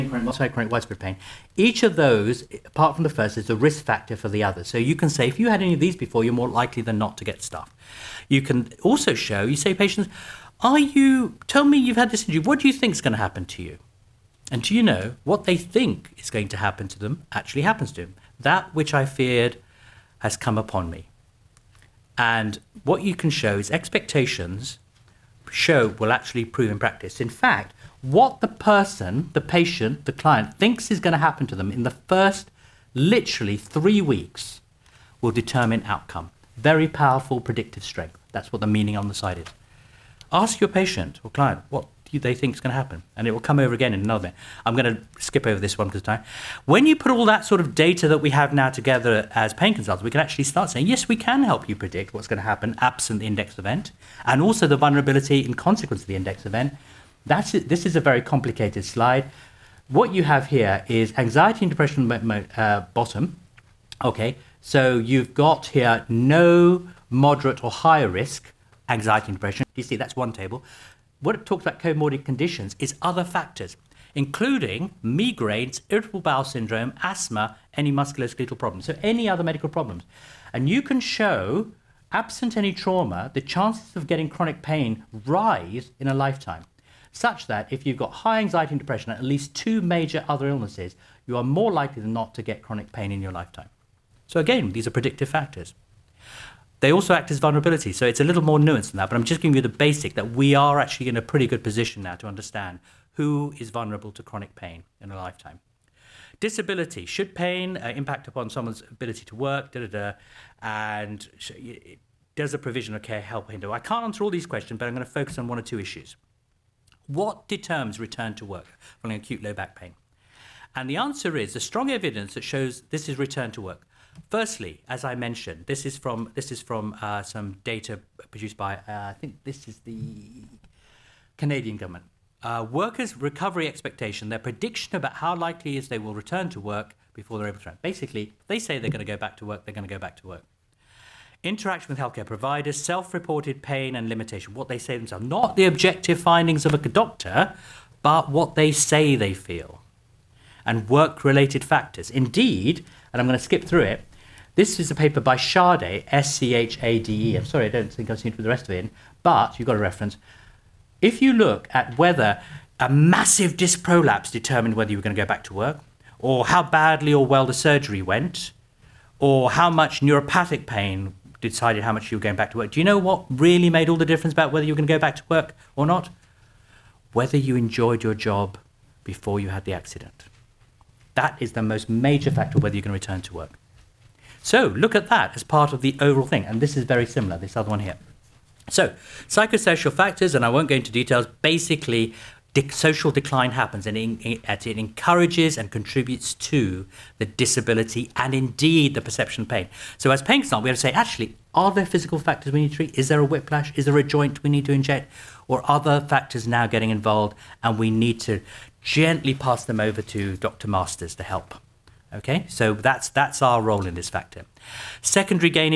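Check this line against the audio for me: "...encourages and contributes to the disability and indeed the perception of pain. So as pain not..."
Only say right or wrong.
right.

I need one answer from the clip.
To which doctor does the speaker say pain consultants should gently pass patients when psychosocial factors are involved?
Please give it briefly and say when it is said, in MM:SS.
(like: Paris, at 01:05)
Dr. Masters, at 03:30.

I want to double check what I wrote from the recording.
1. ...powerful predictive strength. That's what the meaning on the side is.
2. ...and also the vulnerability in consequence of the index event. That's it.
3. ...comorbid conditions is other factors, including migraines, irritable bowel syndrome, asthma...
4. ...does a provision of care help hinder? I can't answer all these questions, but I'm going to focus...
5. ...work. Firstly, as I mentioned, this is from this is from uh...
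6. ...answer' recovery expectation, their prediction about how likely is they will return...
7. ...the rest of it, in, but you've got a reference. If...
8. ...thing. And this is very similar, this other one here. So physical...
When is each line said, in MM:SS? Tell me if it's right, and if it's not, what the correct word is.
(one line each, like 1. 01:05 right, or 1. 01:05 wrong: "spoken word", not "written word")
1. 00:36 right
2. 00:54 right
3. 01:11 right
4. 01:52 right
5. 02:03 right
6. 02:12 wrong: "workers", not "answer"
7. 02:38 right
8. 03:06 wrong: "psychosocial", not "physical".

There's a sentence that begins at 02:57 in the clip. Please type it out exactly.
Whether you enjoyed your job before you had the accident.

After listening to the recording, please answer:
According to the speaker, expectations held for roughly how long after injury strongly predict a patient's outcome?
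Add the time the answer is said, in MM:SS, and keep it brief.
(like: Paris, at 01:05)
3 weeks, at 00:33.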